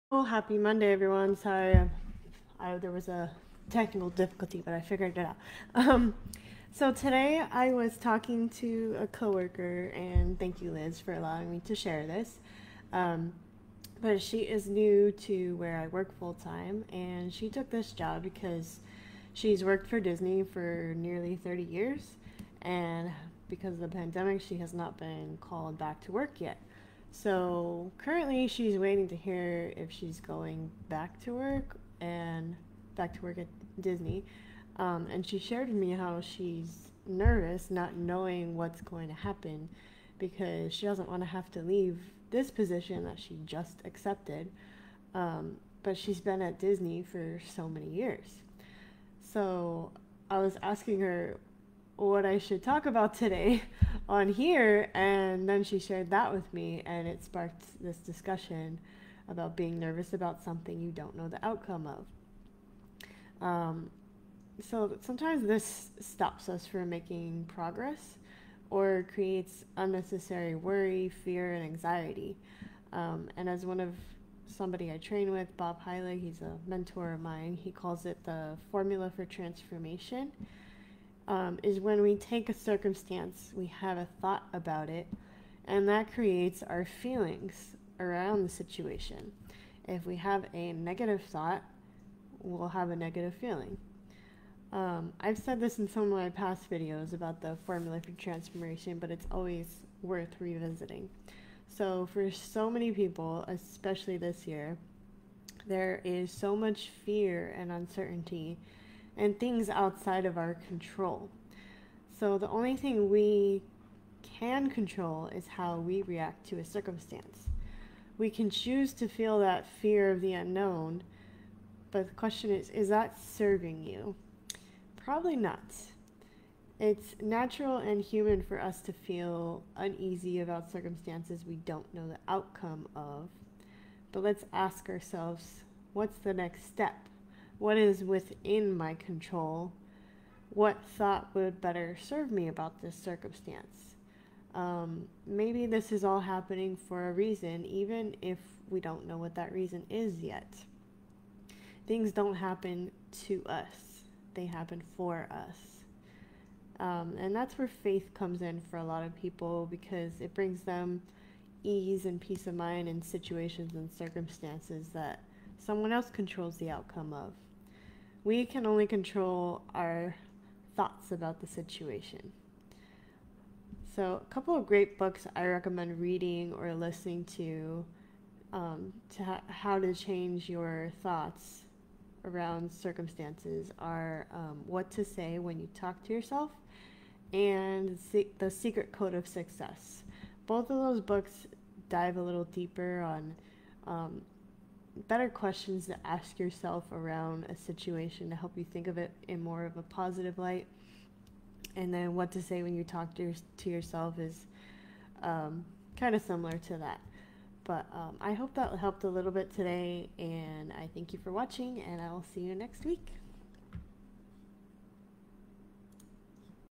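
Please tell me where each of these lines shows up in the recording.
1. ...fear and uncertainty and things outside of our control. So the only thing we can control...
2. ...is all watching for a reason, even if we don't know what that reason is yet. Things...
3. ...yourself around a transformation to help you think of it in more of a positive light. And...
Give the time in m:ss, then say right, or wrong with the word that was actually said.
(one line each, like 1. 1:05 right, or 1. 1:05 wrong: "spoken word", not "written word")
1. 1:47 right
2. 2:25 wrong: "happening", not "watching"
3. 3:16 wrong: "situation", not "transformation".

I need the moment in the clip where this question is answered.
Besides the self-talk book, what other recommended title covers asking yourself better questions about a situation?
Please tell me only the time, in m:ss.
3:08.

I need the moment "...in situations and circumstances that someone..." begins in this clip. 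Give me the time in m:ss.
2:42.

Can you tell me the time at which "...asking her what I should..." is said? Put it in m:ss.
0:50.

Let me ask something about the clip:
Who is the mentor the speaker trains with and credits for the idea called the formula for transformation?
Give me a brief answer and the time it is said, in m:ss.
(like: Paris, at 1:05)
Bob Heilig, at 1:15.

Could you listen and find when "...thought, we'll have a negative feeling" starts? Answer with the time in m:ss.
1:31.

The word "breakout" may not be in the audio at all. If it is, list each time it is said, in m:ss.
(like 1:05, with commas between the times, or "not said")
not said.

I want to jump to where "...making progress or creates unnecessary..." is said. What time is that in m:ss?
1:06.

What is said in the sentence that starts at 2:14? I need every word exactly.
But let's ask ourselves what's the next step?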